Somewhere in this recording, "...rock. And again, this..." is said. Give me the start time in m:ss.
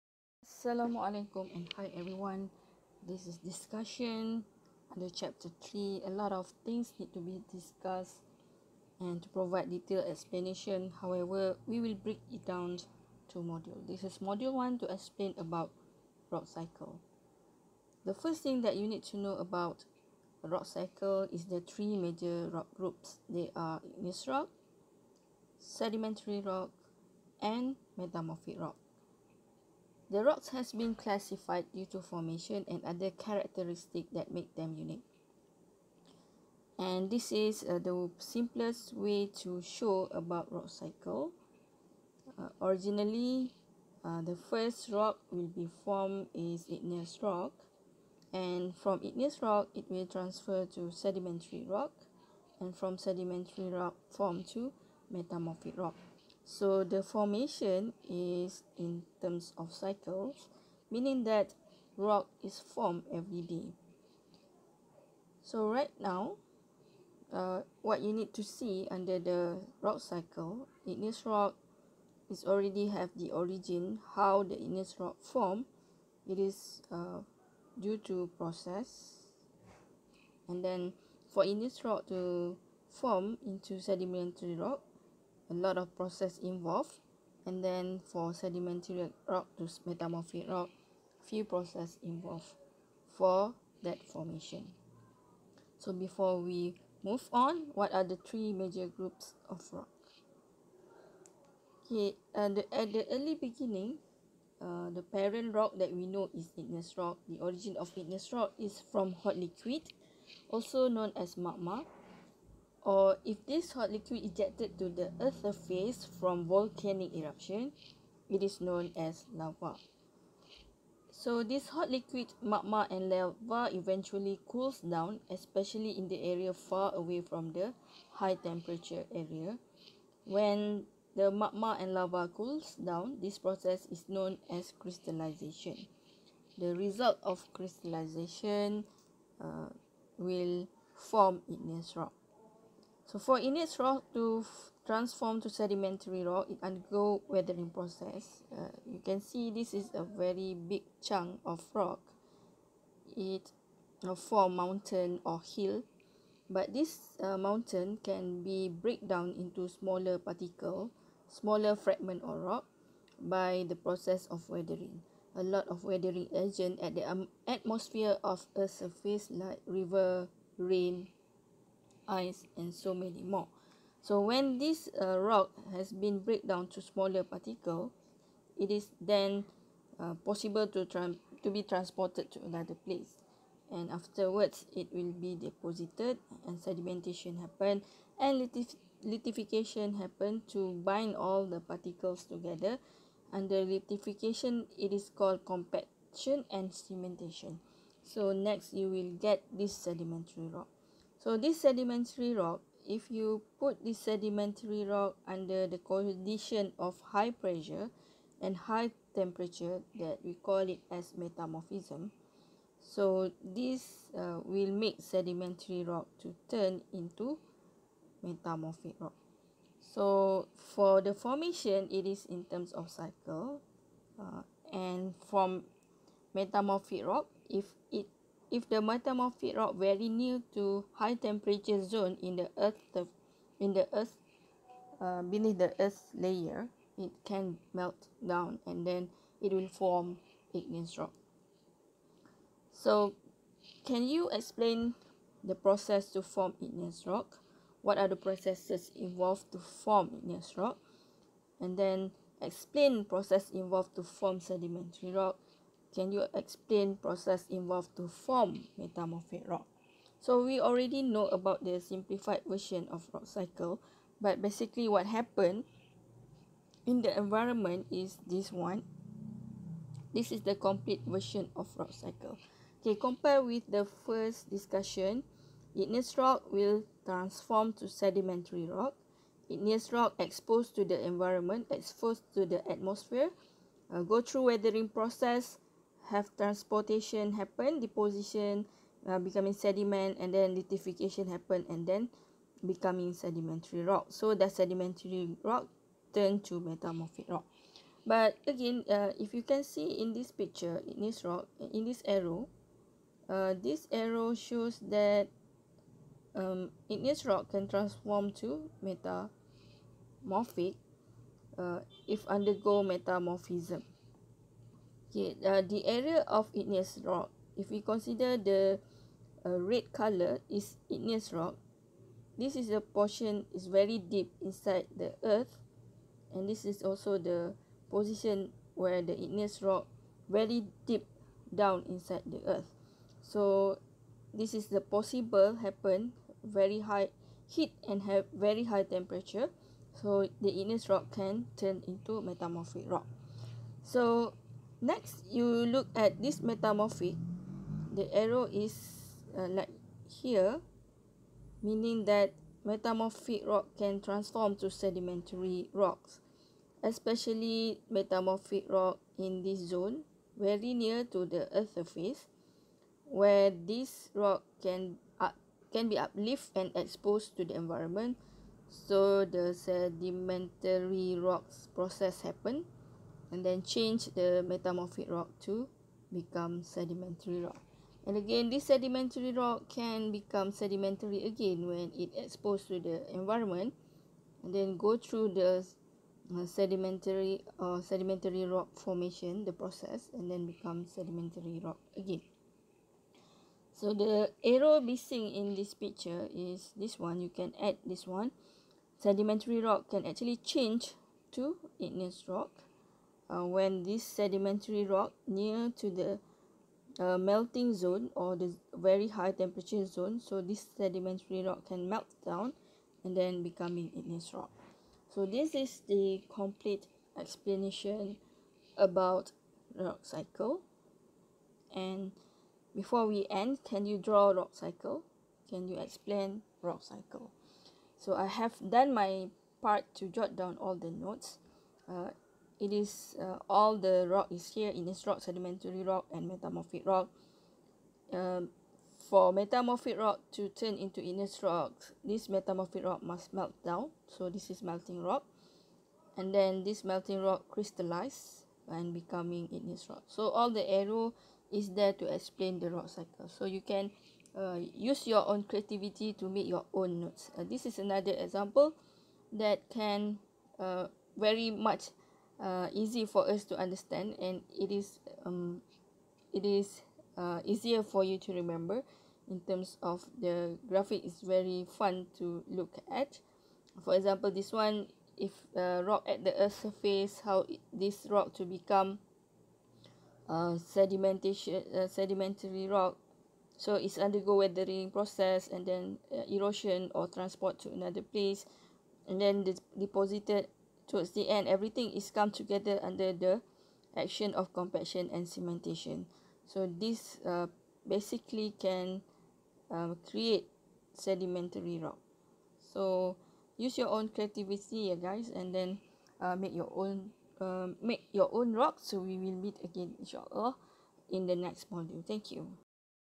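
6:17.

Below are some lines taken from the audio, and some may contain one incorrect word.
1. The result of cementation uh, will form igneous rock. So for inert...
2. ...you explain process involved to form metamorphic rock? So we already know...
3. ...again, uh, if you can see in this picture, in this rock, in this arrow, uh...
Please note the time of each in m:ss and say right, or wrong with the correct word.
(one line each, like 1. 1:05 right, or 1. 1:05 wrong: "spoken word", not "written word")
1. 2:16 wrong: "crystallization", not "cementation"
2. 4:16 right
3. 4:58 right.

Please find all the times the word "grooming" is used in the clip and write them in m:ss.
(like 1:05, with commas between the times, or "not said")
not said.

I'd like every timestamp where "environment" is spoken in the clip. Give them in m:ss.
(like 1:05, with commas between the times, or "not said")
4:27, 4:41, 6:07, 6:23.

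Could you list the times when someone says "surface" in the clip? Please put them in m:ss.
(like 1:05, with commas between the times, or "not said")
1:55, 2:48, 6:01, 7:56.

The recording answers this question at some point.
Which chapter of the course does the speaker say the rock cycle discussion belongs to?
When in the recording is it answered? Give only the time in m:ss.
0:05.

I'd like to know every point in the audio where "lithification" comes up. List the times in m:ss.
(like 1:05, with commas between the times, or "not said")
4:50.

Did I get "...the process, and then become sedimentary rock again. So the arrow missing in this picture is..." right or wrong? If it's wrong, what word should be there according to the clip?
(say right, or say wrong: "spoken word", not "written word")
right.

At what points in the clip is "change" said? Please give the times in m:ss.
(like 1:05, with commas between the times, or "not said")
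6:13, 6:40.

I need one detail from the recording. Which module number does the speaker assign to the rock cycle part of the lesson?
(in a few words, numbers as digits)
1.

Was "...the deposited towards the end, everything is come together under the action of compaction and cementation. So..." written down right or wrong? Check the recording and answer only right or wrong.
right.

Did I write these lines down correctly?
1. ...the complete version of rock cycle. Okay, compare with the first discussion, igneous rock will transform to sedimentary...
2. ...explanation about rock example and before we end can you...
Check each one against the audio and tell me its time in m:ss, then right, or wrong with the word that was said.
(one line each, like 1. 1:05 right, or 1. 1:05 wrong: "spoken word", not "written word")
1. 4:30 right
2. 6:57 wrong: "cycle", not "example".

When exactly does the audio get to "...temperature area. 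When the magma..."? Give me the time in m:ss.
2:08.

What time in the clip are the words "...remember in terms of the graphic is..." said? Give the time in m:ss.
7:48.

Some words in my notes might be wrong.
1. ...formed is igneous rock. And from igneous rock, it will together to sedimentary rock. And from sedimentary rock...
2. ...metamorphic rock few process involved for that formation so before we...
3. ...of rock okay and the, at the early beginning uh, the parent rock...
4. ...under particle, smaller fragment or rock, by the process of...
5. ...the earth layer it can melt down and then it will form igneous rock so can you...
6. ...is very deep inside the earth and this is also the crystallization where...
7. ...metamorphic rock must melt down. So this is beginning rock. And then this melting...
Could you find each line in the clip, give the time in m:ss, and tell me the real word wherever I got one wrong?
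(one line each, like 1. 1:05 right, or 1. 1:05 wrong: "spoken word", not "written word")
1. 0:45 wrong: "transfer", not "together"
2. 1:29 right
3. 1:39 right
4. 2:39 wrong: "smaller", not "under"
5. 3:55 right
6. 5:23 wrong: "position", not "crystallization"
7. 7:22 wrong: "melting", not "beginning".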